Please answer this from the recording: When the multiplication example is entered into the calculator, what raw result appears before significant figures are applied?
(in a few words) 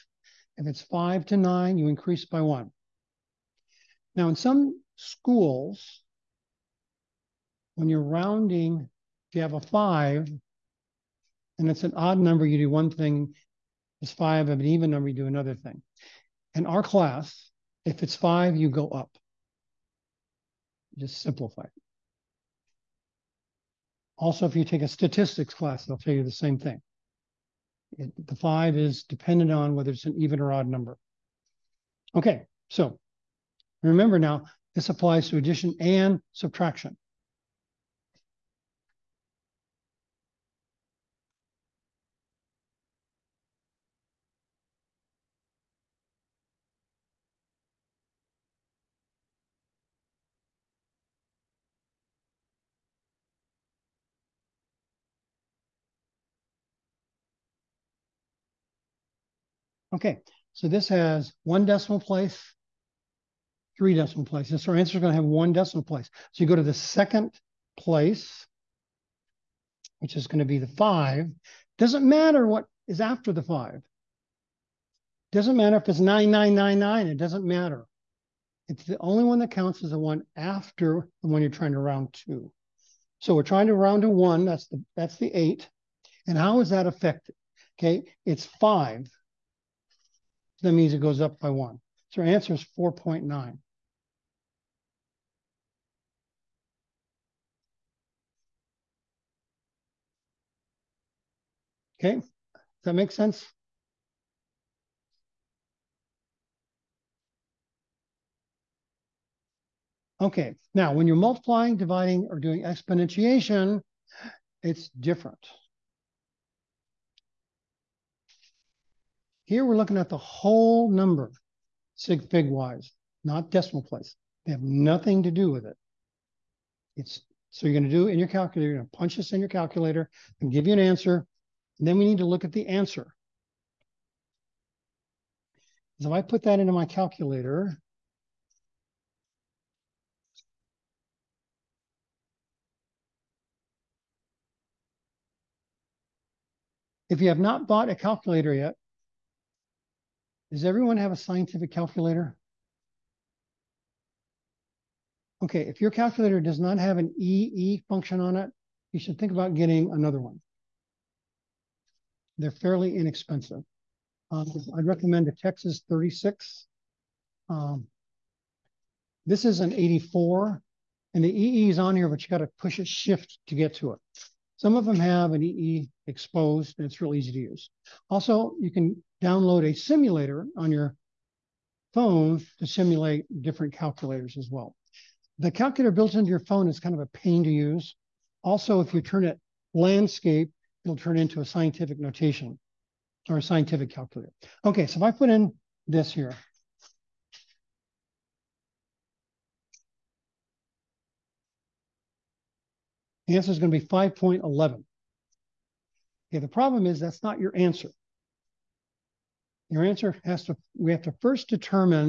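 5.11.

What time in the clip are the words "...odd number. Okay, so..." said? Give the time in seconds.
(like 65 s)
30 s.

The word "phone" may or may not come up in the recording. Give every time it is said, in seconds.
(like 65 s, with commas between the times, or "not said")
181 s, 186 s.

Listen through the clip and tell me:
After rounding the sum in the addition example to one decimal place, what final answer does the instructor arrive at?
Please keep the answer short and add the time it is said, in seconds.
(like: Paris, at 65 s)
4.9, at 92 s.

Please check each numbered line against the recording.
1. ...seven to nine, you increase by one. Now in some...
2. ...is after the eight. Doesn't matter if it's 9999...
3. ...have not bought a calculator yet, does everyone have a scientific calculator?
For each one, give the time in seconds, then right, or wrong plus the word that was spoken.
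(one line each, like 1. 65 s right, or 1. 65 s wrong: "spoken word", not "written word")
1. 0 s wrong: "five", not "seven"
2. 72 s wrong: "five", not "eight"
3. 147 s right.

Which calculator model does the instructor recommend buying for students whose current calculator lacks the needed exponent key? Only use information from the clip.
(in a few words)
Texas 36.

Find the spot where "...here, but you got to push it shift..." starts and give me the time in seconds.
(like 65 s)
171 s.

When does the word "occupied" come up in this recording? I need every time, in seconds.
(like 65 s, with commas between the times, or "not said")
not said.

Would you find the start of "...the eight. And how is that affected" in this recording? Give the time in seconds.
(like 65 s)
85 s.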